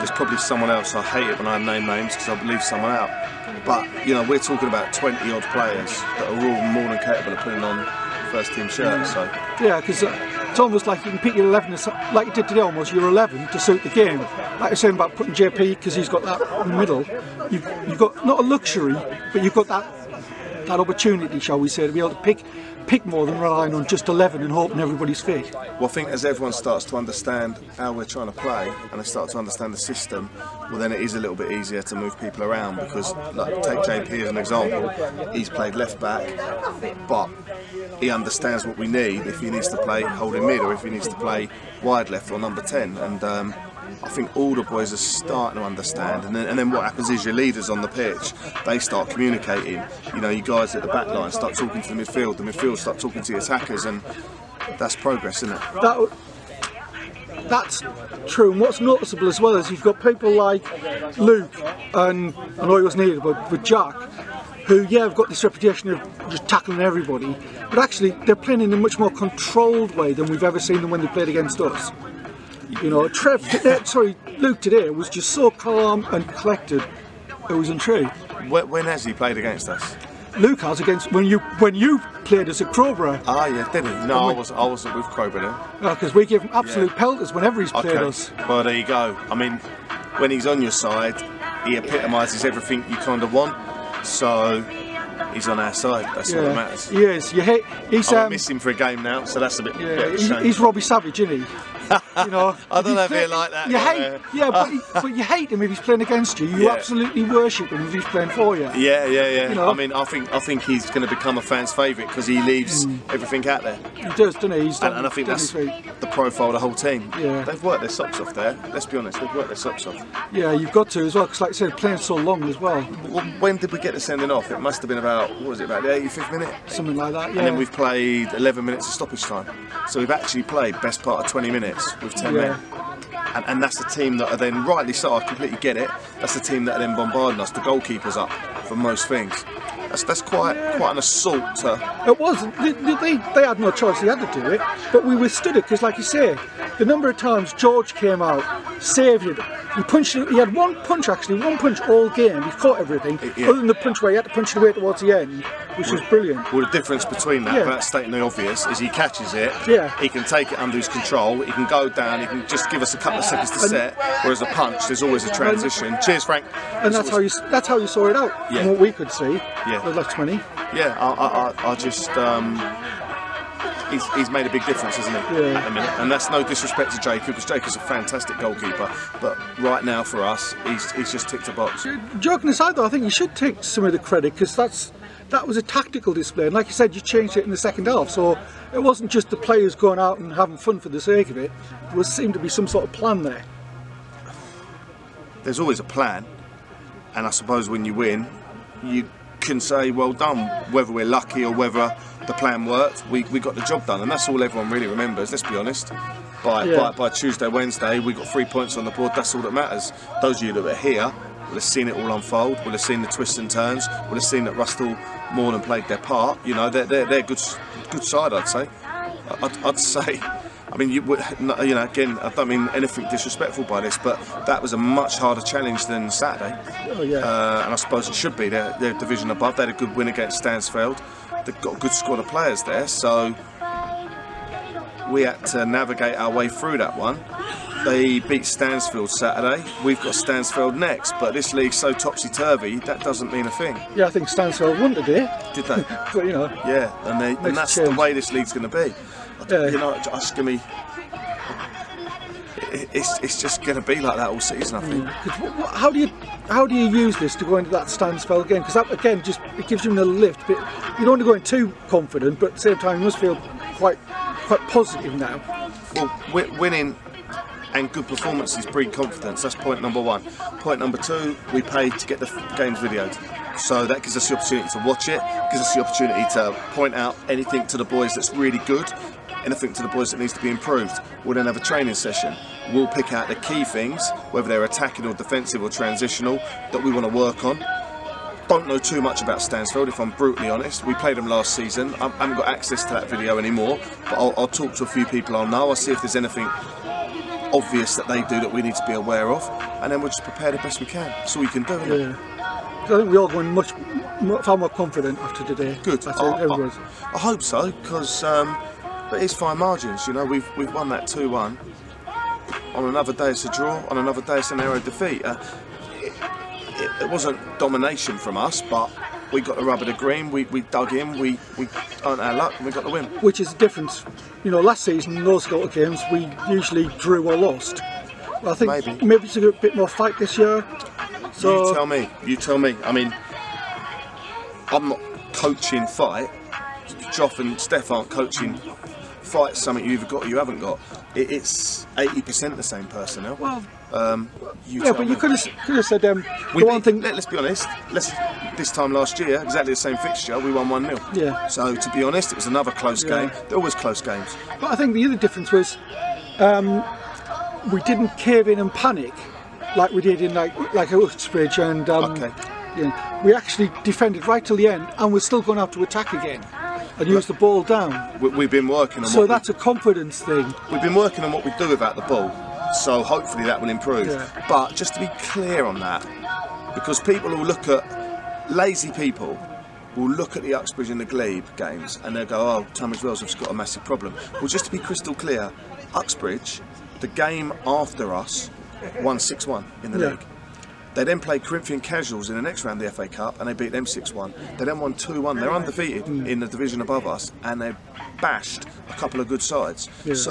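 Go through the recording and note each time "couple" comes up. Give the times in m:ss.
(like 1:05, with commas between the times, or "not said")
2:42, 6:38.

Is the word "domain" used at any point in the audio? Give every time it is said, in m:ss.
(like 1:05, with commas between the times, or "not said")
not said.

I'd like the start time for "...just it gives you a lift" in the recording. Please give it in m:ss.
4:19.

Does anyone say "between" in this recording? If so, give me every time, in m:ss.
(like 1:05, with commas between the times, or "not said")
2:37.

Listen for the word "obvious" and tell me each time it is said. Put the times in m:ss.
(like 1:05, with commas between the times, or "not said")
2:38, 4:57.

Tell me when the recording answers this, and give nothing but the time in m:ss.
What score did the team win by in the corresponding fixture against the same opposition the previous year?
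5:50.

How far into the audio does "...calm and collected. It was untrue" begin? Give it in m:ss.
1:15.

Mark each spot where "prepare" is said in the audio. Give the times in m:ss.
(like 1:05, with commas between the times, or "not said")
5:00.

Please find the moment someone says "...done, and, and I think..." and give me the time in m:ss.
1:54.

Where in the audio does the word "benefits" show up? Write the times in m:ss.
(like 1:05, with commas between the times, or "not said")
not said.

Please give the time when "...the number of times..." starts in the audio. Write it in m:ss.
2:26.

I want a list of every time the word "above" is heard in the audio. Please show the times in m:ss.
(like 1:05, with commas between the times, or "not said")
3:49, 6:36.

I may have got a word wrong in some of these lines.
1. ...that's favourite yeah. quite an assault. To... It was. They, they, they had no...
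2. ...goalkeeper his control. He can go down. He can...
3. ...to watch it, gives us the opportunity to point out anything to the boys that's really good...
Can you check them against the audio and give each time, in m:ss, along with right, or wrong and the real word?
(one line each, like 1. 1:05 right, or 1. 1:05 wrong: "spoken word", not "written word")
1. 2:20 wrong: "quite", not "favourite"
2. 2:40 wrong: "under", not "goalkeeper"
3. 4:34 right.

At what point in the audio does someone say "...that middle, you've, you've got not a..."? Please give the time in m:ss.
0:16.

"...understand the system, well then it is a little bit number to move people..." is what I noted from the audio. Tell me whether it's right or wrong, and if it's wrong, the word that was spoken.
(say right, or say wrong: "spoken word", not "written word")
wrong: "easier", not "number".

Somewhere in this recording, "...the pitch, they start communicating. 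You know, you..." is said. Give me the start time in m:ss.
0:47.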